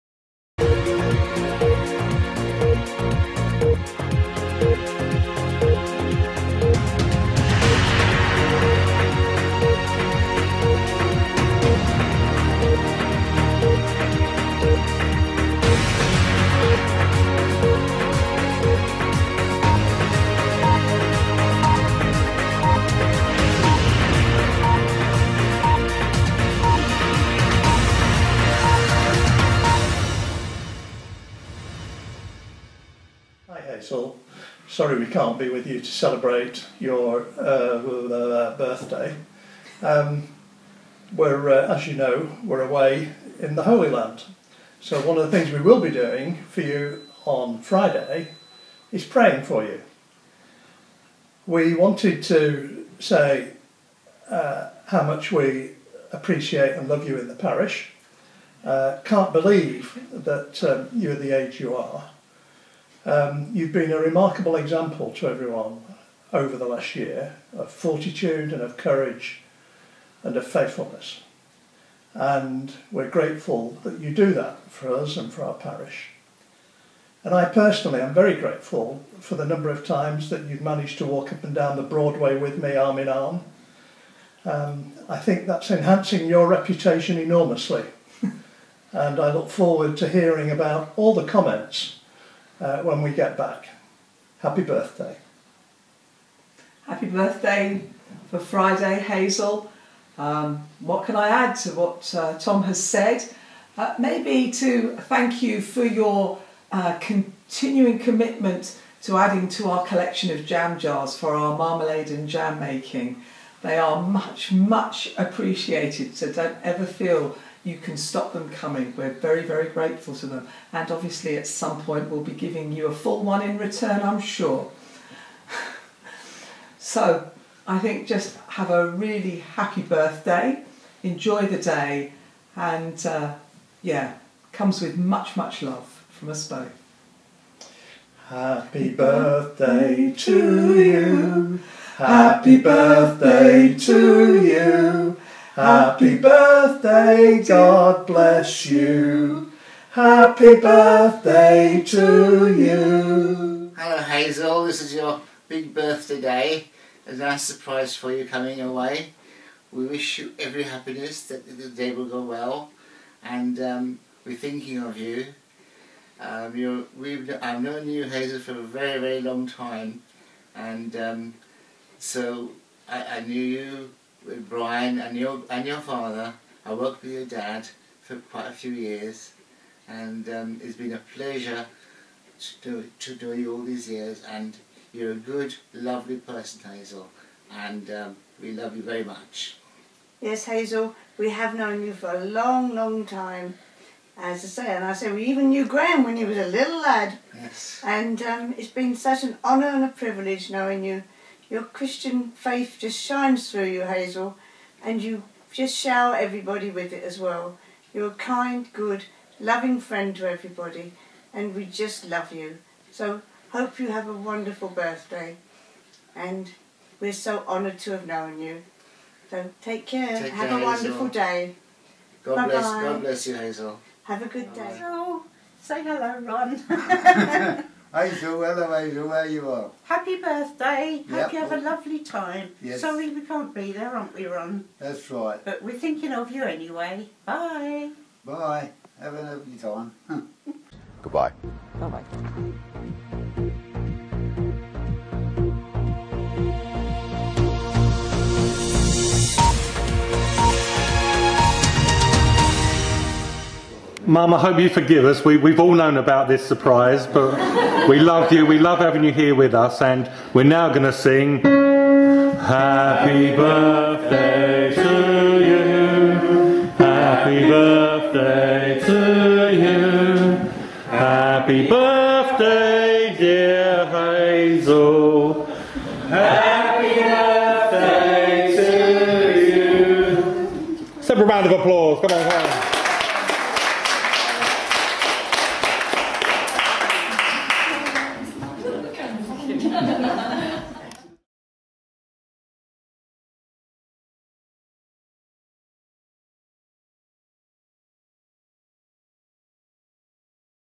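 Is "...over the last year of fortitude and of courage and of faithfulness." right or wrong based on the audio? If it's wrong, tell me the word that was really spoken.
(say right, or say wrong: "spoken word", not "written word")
right.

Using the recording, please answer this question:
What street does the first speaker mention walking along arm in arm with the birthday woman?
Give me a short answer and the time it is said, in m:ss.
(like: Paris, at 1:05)
The Broadway, at 1:21.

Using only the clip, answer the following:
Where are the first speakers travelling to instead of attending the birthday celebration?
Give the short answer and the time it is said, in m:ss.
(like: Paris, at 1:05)
The Holy Land, at 0:43.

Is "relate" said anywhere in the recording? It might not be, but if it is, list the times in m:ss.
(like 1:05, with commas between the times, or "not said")
not said.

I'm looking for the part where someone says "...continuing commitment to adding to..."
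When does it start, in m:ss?
1:46.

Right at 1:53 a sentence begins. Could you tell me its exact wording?
They are much, much appreciated, so don't ever feel you can stop them coming.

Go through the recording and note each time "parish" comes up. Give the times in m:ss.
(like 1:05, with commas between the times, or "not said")
0:57, 1:15.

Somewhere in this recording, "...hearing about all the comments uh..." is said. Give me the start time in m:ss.
1:30.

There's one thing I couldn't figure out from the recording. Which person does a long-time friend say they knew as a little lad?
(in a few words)
Graham.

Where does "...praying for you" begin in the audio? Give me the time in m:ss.
0:49.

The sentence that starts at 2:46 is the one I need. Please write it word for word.
Um, I've known you, Hazel, for a very, very long time.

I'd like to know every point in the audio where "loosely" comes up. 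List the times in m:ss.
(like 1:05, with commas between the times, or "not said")
not said.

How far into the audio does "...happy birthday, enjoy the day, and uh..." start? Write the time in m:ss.
2:09.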